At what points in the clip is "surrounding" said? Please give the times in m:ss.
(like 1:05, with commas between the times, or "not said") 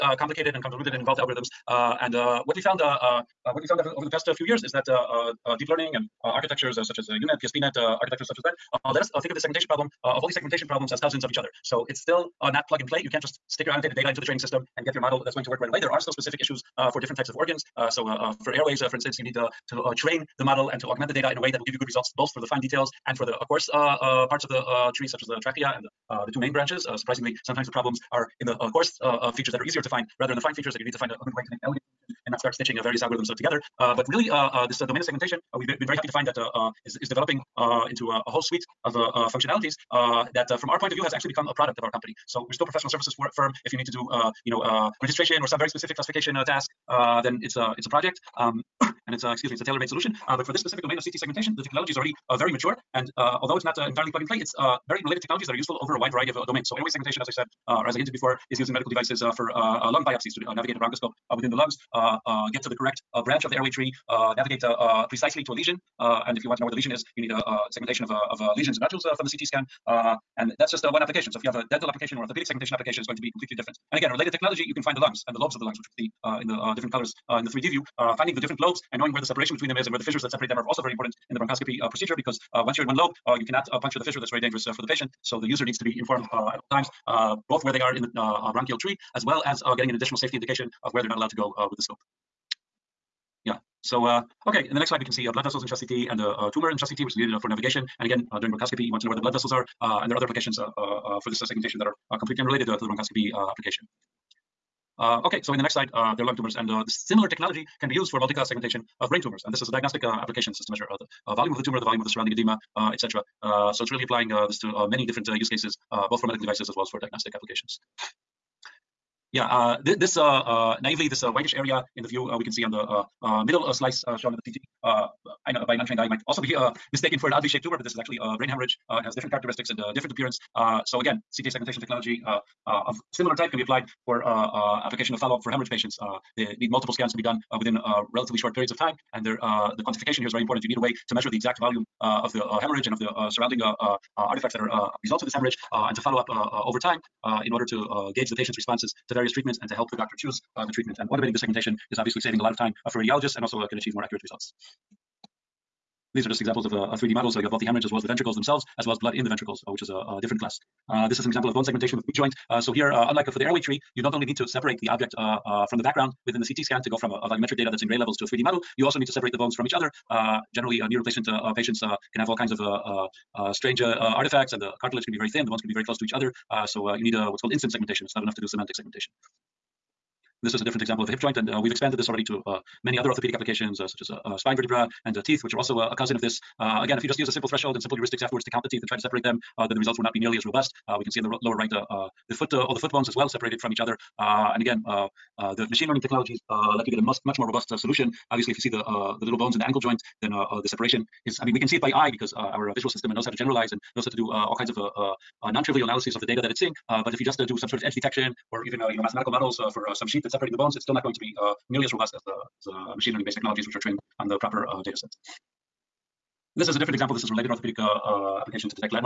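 1:52, 2:23.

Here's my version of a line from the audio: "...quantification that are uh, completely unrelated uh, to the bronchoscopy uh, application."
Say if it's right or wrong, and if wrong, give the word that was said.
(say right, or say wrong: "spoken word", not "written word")
wrong: "segmentation", not "quantification".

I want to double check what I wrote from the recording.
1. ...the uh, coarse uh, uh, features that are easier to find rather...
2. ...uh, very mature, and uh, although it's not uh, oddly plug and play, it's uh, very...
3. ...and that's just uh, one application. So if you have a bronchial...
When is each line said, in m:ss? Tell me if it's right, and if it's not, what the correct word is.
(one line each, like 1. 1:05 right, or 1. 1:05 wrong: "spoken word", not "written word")
1. 0:28 right
2. 0:52 wrong: "entirely", not "oddly"
3. 1:10 wrong: "dental", not "bronchial".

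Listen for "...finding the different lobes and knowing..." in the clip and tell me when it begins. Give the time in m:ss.
1:18.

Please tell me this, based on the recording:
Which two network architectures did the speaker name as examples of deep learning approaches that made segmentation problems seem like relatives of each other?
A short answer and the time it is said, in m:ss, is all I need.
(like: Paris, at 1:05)
UNet, PSPNet, at 0:07.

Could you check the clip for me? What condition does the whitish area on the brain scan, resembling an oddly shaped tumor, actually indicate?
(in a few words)
Brain hemorrhage.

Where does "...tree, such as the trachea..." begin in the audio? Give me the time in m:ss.
0:24.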